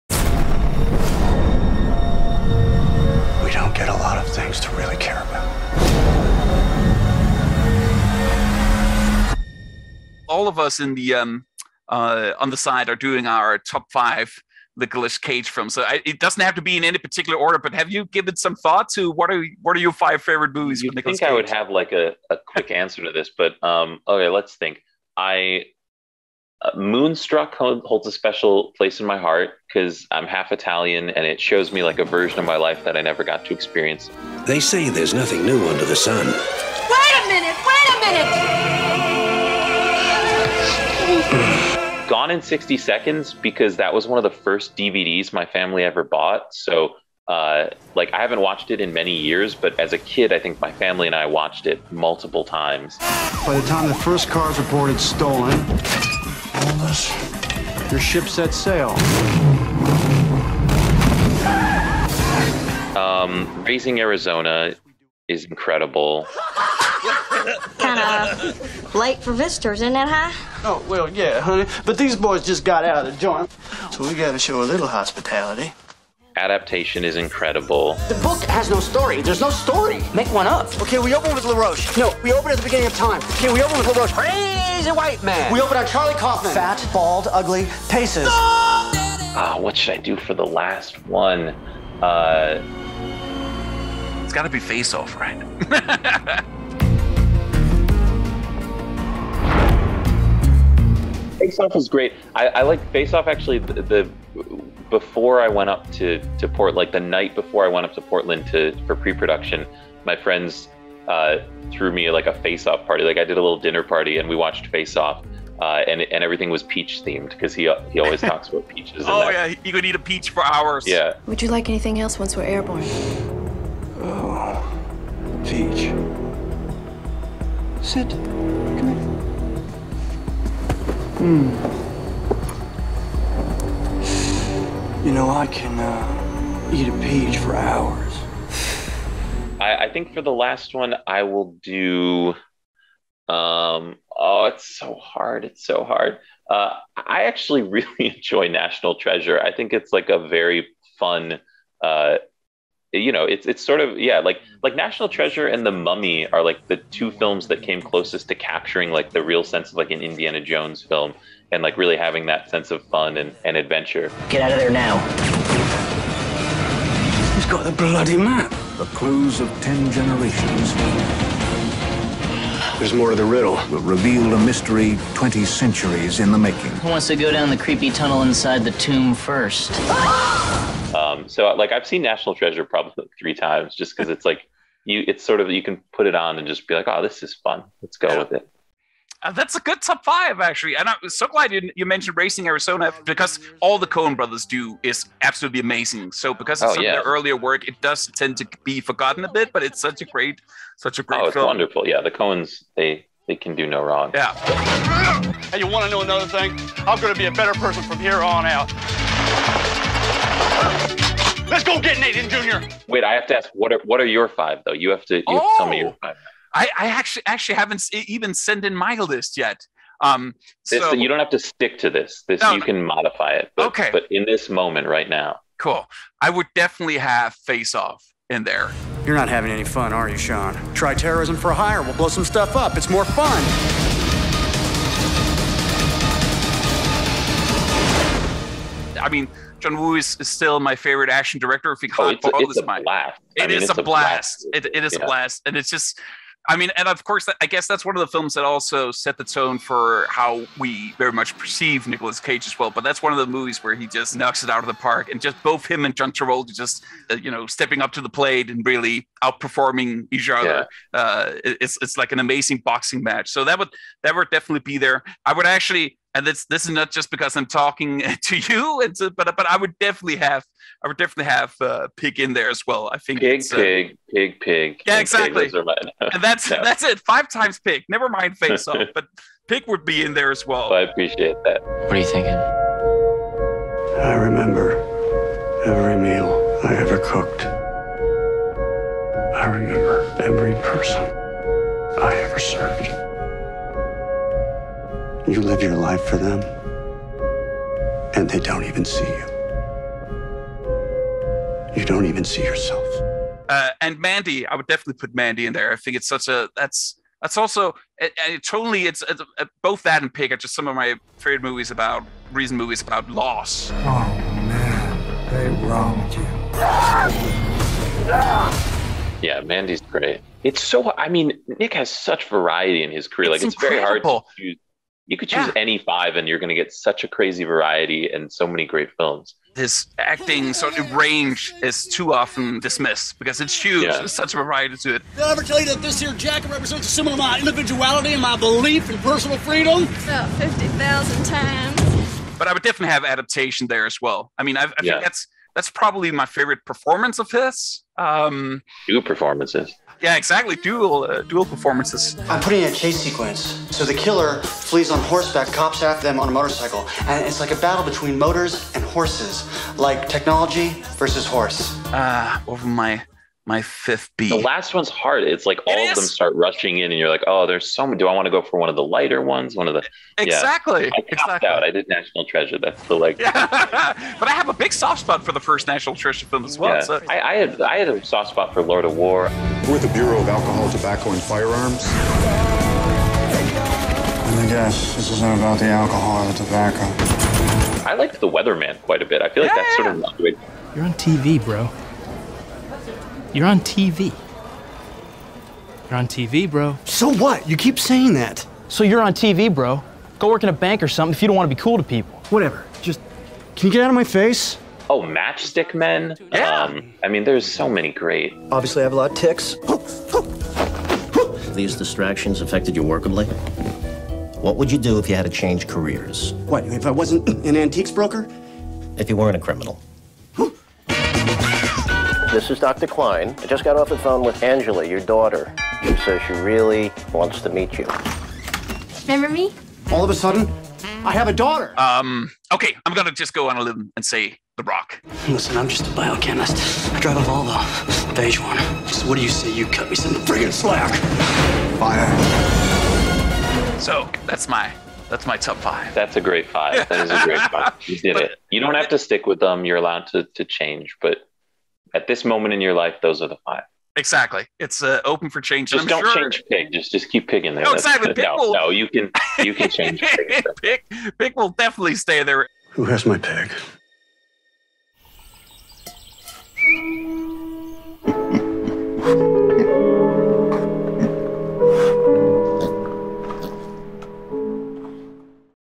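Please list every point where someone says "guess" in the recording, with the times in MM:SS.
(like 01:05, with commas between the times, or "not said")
04:07, 06:24.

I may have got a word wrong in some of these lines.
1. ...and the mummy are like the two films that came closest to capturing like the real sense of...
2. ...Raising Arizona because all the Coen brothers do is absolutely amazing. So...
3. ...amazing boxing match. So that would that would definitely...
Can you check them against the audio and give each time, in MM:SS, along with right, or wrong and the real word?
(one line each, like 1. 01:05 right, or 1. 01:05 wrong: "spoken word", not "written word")
1. 02:35 right
2. 03:12 right
3. 04:22 right.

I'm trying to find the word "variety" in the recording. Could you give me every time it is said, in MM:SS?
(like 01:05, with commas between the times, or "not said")
05:22, 05:27, 05:34.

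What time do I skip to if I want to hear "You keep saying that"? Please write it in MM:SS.
06:37.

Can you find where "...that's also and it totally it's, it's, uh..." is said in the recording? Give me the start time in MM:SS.
05:07.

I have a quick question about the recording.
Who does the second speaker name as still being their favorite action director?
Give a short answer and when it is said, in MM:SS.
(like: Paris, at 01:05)
John Woo, at 03:59.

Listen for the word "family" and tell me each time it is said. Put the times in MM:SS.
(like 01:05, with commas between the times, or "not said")
00:45, 00:50.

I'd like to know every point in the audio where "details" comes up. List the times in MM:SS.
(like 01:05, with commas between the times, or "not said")
not said.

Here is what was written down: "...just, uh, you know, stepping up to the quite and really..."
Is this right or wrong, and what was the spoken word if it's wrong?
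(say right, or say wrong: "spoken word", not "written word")
wrong: "plate", not "quite".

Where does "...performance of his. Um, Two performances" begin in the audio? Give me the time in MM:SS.
05:46.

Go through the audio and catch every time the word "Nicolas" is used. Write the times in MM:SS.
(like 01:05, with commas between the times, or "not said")
00:14, 04:11.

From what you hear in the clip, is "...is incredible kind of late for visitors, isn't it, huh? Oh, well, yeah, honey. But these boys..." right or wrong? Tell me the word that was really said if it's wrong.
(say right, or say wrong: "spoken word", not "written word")
right.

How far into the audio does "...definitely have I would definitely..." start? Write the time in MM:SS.
04:29.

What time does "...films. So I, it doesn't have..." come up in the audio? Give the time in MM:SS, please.
00:15.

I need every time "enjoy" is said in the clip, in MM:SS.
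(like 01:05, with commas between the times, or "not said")
02:28.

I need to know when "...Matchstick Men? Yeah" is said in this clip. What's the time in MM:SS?
06:45.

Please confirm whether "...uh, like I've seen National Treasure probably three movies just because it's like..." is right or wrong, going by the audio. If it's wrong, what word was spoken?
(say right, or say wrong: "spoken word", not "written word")
wrong: "times", not "movies".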